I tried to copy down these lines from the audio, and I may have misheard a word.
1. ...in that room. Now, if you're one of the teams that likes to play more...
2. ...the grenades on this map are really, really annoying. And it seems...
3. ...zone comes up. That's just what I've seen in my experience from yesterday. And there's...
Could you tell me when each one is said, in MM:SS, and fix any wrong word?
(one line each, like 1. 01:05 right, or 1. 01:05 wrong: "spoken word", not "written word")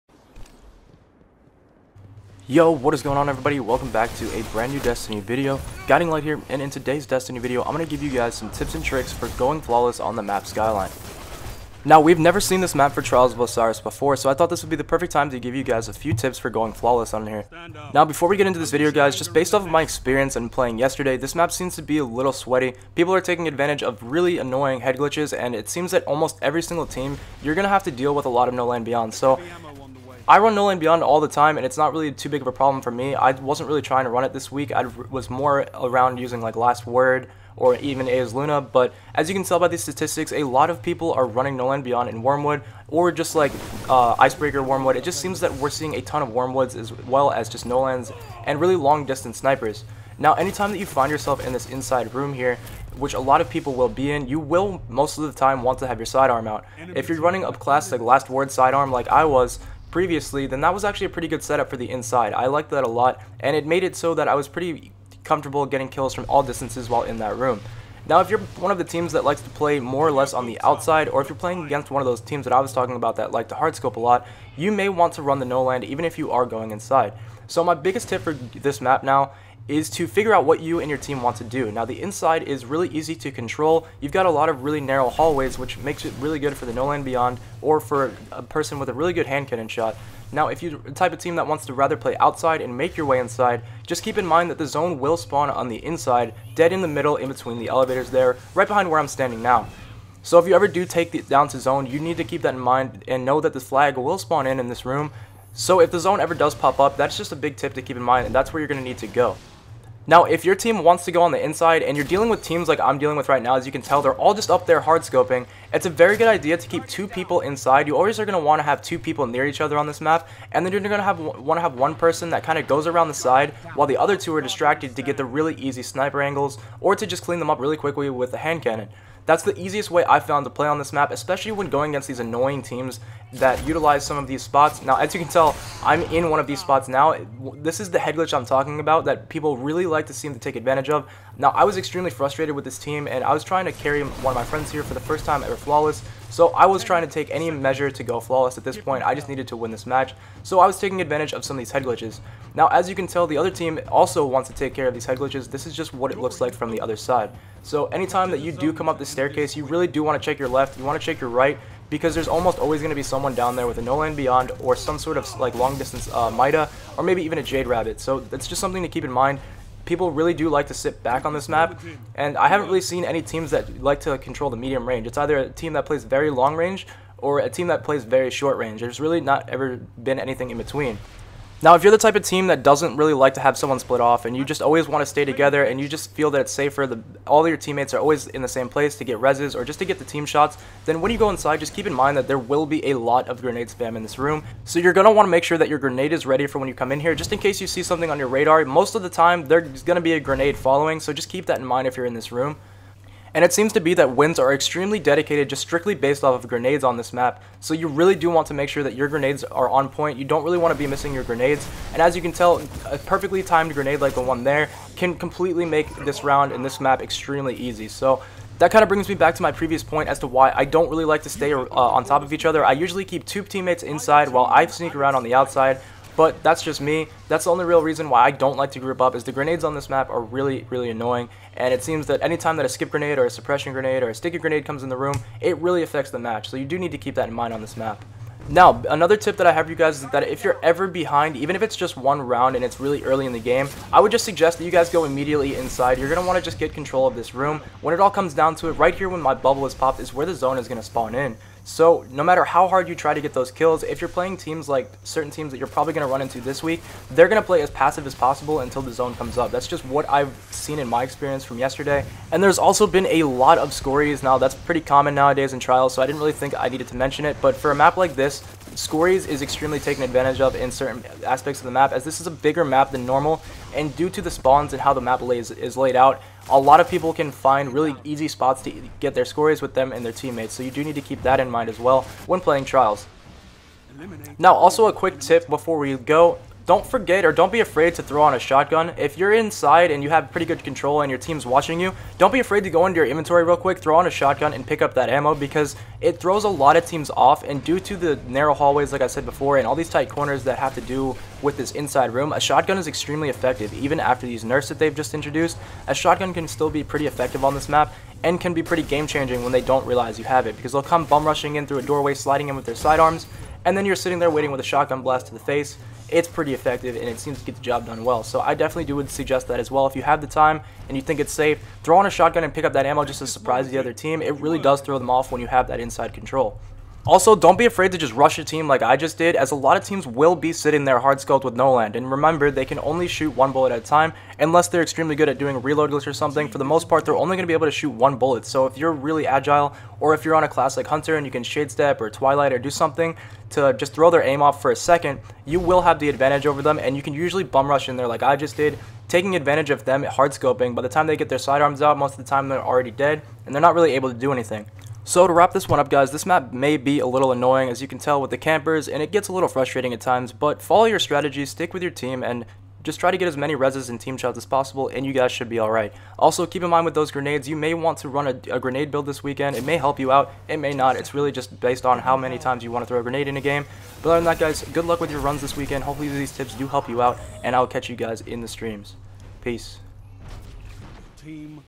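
1. 01:07 right
2. 03:49 right
3. 04:18 right.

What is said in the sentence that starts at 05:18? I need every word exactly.
So I definitely do would suggest that as well.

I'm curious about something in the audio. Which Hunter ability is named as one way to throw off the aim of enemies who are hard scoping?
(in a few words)
Shade Step.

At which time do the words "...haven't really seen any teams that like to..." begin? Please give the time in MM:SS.
02:52.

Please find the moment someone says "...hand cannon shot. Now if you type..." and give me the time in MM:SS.
01:29.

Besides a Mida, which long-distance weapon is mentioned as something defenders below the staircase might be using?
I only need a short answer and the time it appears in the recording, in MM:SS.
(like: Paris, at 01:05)
Jade Rabbit, at 02:47.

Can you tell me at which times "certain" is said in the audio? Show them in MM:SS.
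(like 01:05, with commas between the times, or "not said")
04:15, 04:30.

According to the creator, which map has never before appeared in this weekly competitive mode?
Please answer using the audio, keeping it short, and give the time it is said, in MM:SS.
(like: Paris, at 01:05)
Skyline, at 00:10.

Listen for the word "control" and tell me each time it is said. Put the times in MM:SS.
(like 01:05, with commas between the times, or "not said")
01:23, 02:54, 04:06, 04:50, 05:26.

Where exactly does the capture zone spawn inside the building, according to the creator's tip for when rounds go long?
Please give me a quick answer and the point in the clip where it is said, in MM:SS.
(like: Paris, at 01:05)
between the elevators, at 01:37.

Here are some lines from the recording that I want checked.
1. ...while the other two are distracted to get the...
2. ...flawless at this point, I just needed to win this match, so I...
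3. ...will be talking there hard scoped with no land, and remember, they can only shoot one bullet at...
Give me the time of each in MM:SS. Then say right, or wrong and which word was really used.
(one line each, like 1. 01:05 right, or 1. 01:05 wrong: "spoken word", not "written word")
1. 02:03 right
2. 02:28 right
3. 05:30 wrong: "sitting", not "talking".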